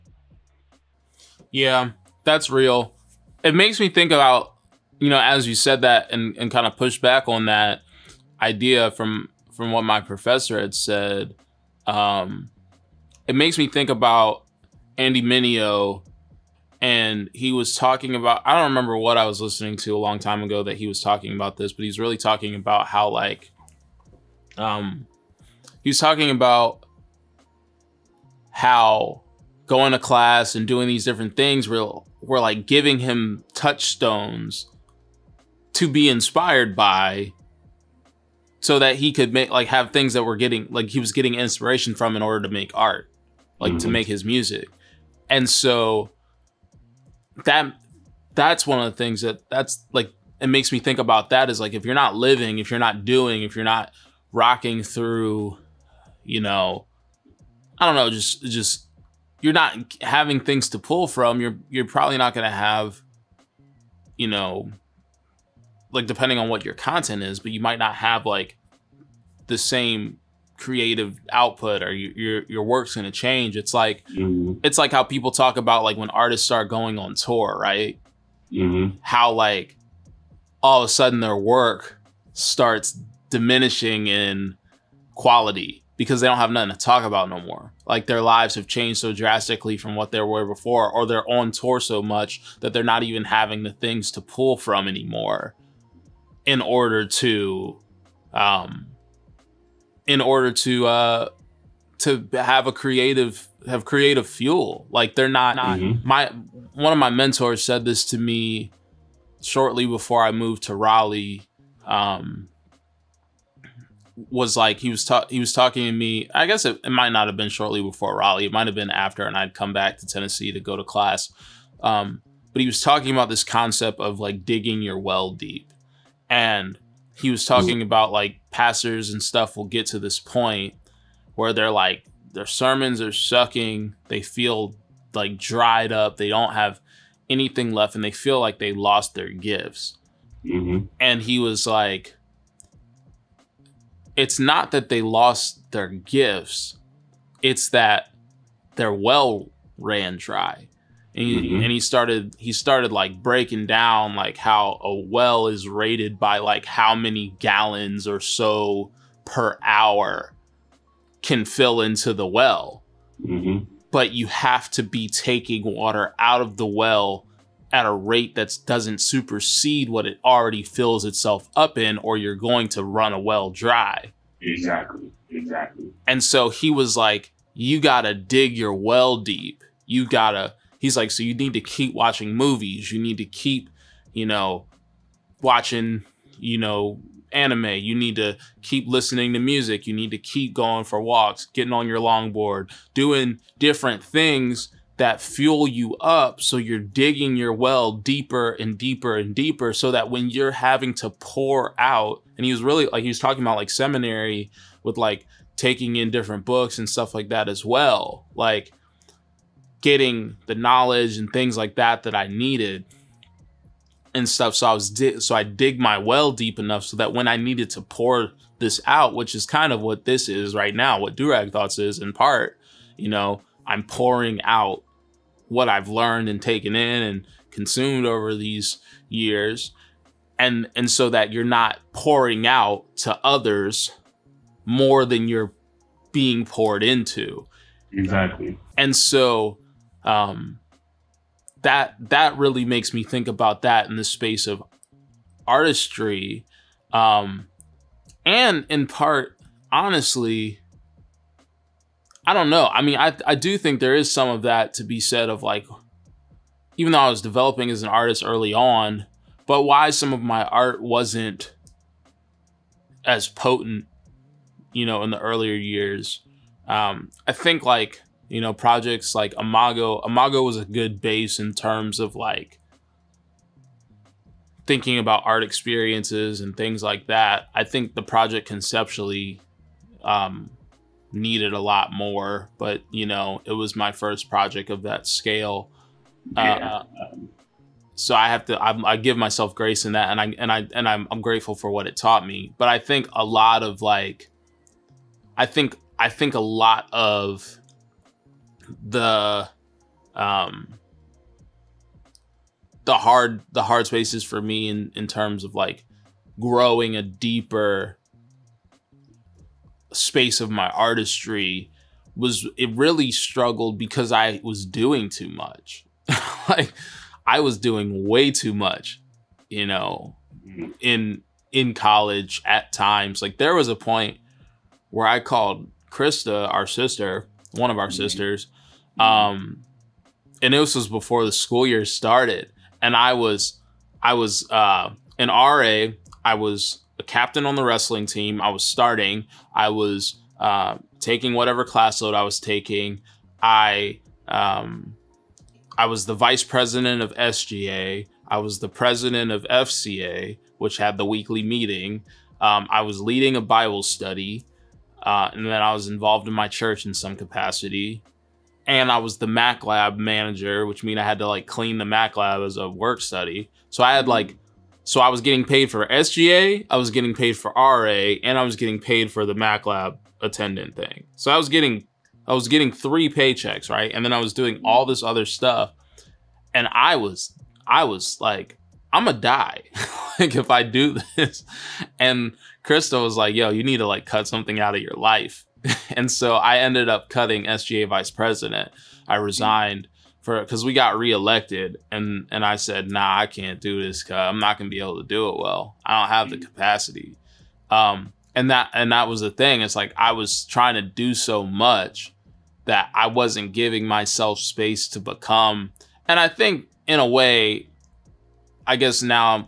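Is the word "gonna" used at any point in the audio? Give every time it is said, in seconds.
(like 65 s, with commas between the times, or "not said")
379 s, 394 s.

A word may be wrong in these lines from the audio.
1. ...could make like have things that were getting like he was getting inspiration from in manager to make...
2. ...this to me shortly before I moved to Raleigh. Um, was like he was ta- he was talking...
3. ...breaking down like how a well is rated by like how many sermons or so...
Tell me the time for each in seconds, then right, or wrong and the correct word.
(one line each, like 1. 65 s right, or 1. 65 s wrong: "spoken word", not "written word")
1. 39 s wrong: "order", not "manager"
2. 107 s right
3. 153 s wrong: "gallons", not "sermons".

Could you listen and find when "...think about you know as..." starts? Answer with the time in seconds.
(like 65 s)
3 s.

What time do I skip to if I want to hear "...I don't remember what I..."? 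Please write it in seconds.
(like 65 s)
18 s.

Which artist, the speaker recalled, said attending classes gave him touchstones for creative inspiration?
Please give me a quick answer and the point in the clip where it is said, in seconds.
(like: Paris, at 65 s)
Andy Mineo, at 14 s.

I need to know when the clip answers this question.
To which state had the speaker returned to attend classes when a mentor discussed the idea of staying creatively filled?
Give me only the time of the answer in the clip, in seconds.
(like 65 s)
120 s.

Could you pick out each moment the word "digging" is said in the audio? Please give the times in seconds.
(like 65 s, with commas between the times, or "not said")
124 s, 196 s.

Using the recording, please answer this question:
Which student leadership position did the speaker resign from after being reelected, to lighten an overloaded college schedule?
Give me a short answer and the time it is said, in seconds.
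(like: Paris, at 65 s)
SGA vice president, at 387 s.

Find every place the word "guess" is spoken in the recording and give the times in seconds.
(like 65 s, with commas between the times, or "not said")
116 s, 408 s.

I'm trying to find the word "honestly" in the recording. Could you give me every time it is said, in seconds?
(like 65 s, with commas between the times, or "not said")
249 s.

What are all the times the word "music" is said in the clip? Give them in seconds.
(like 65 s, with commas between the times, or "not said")
44 s, 189 s.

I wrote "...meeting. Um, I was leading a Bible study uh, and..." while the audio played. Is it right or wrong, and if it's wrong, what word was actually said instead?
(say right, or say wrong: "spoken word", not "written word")
right.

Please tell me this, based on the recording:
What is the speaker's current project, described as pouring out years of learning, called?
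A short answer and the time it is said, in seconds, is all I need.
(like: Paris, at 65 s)
Durag Thoughts, at 221 s.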